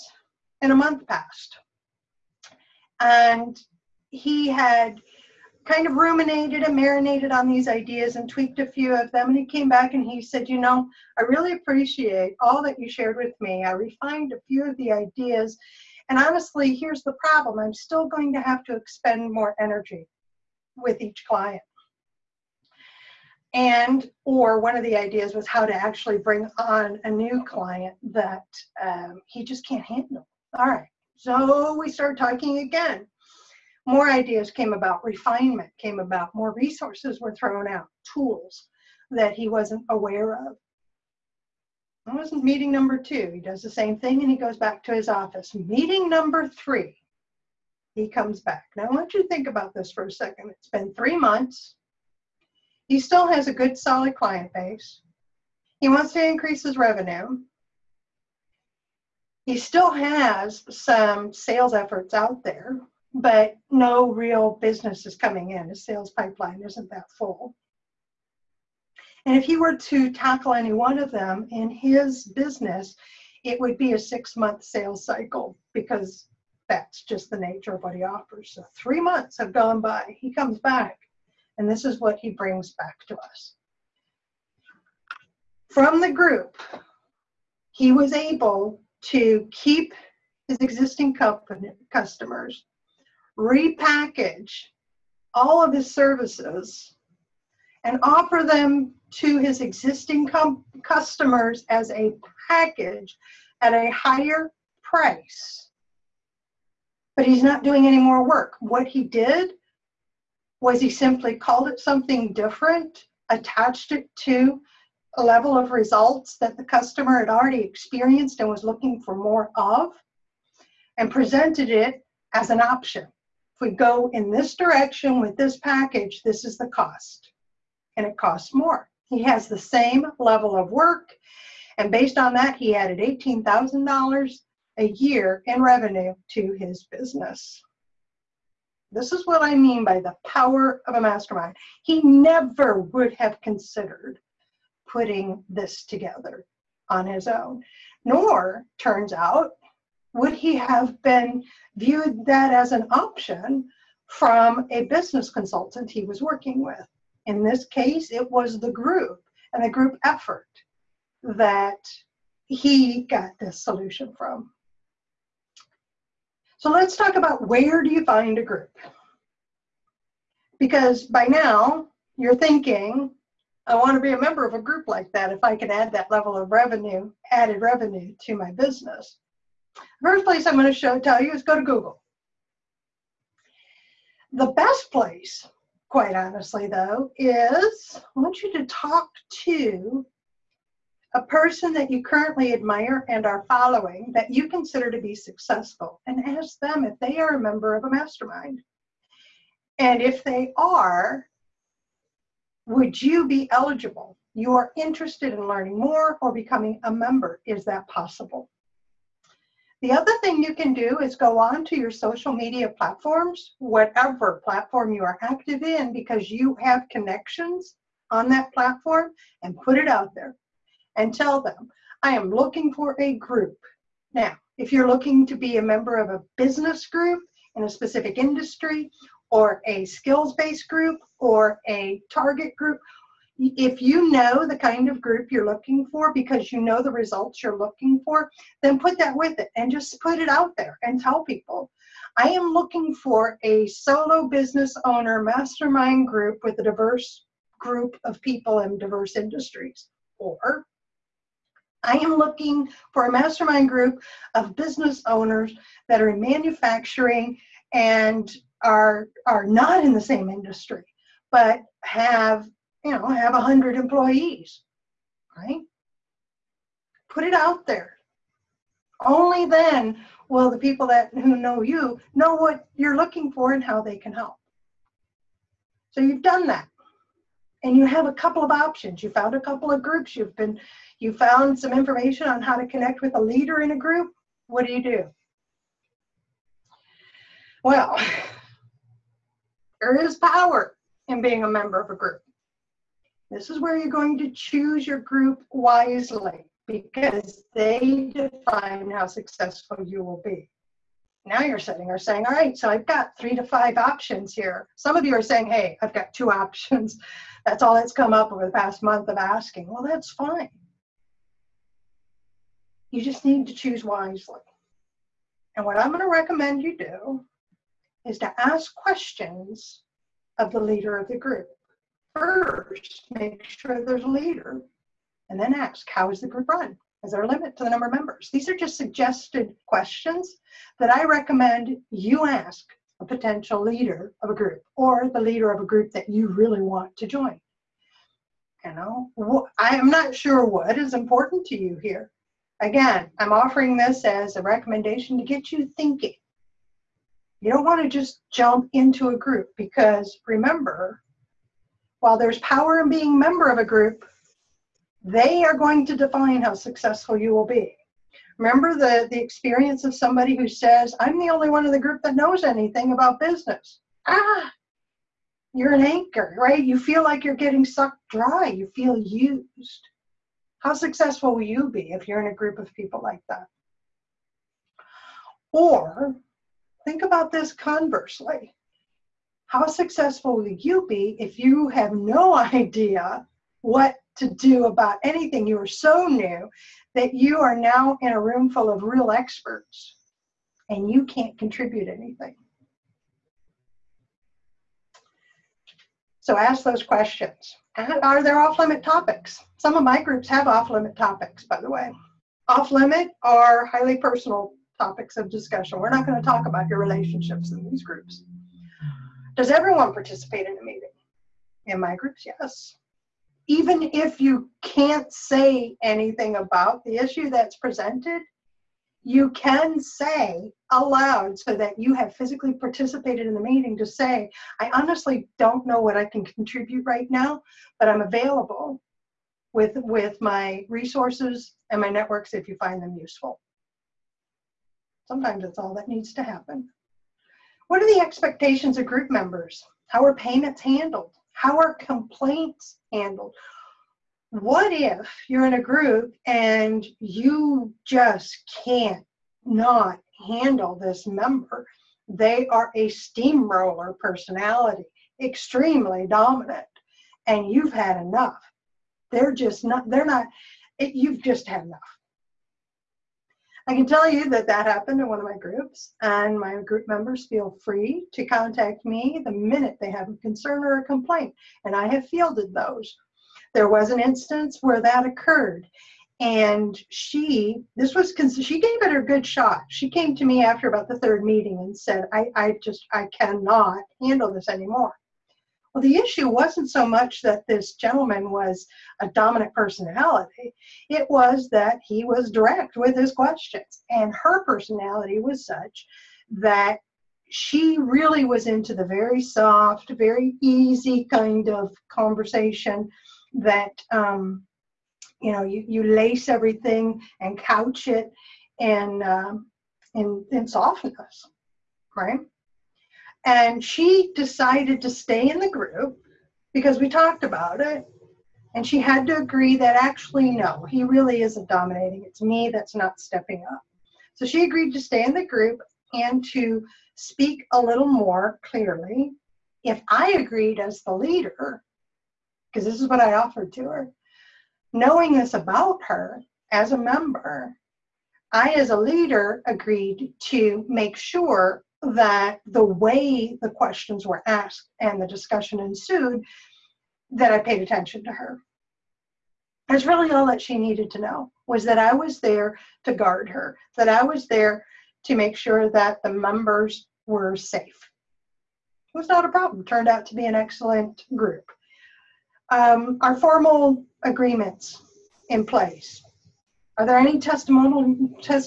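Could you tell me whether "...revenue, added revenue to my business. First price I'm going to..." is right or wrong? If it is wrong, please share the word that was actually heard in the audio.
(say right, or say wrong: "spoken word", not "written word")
wrong: "place", not "price".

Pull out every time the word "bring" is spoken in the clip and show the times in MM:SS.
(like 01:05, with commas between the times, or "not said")
00:26, 01:22.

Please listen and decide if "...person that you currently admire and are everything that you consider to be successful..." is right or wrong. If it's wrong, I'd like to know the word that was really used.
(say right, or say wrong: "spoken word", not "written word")
wrong: "following", not "everything".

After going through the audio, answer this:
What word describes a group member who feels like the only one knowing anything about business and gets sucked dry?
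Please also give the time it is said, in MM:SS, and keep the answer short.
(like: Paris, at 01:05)
anchor, at 06:05.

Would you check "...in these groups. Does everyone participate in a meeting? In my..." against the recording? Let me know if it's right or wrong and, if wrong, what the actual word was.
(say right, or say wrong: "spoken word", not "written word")
right.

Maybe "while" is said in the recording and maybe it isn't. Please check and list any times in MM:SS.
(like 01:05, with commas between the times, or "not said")
05:51.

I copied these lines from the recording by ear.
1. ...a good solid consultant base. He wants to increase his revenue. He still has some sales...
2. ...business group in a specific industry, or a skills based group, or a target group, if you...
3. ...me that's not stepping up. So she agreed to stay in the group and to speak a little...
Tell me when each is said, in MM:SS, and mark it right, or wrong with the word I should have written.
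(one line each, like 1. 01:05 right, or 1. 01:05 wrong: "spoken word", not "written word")
1. 00:53 wrong: "client", not "consultant"
2. 03:46 right
3. 08:42 right.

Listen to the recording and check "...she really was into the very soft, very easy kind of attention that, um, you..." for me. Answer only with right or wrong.
wrong.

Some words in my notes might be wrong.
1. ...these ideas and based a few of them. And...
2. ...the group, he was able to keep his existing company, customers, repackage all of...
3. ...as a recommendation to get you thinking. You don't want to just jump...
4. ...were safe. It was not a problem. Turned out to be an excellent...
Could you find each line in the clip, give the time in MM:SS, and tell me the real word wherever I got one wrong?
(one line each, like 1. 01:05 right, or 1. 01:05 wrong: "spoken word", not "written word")
1. 00:07 wrong: "tweaked", not "based"
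2. 01:26 right
3. 05:44 right
4. 09:17 right.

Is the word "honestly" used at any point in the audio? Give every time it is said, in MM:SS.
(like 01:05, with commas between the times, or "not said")
00:16, 03:06, 07:04.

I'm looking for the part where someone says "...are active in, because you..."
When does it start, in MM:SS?
03:35.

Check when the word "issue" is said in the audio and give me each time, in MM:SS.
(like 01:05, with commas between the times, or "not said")
06:56, 08:05.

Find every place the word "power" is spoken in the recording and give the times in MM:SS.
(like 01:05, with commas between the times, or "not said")
02:20, 04:50, 05:52.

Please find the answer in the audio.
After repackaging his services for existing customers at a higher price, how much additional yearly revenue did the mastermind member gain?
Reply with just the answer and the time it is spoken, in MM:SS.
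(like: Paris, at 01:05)
$18,000, at 02:12.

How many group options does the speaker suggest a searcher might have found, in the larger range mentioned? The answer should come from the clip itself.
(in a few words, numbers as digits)
3 to 5.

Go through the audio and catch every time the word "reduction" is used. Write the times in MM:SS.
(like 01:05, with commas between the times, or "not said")
not said.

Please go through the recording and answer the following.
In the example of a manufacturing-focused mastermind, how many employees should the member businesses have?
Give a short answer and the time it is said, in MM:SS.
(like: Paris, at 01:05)
100, at 04:23.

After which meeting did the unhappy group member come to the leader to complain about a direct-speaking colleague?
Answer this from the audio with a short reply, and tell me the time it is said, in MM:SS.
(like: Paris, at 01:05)
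the third meeting, at 08:00.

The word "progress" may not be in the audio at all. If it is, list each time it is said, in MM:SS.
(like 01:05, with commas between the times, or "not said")
not said.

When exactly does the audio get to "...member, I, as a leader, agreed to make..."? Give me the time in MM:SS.
08:56.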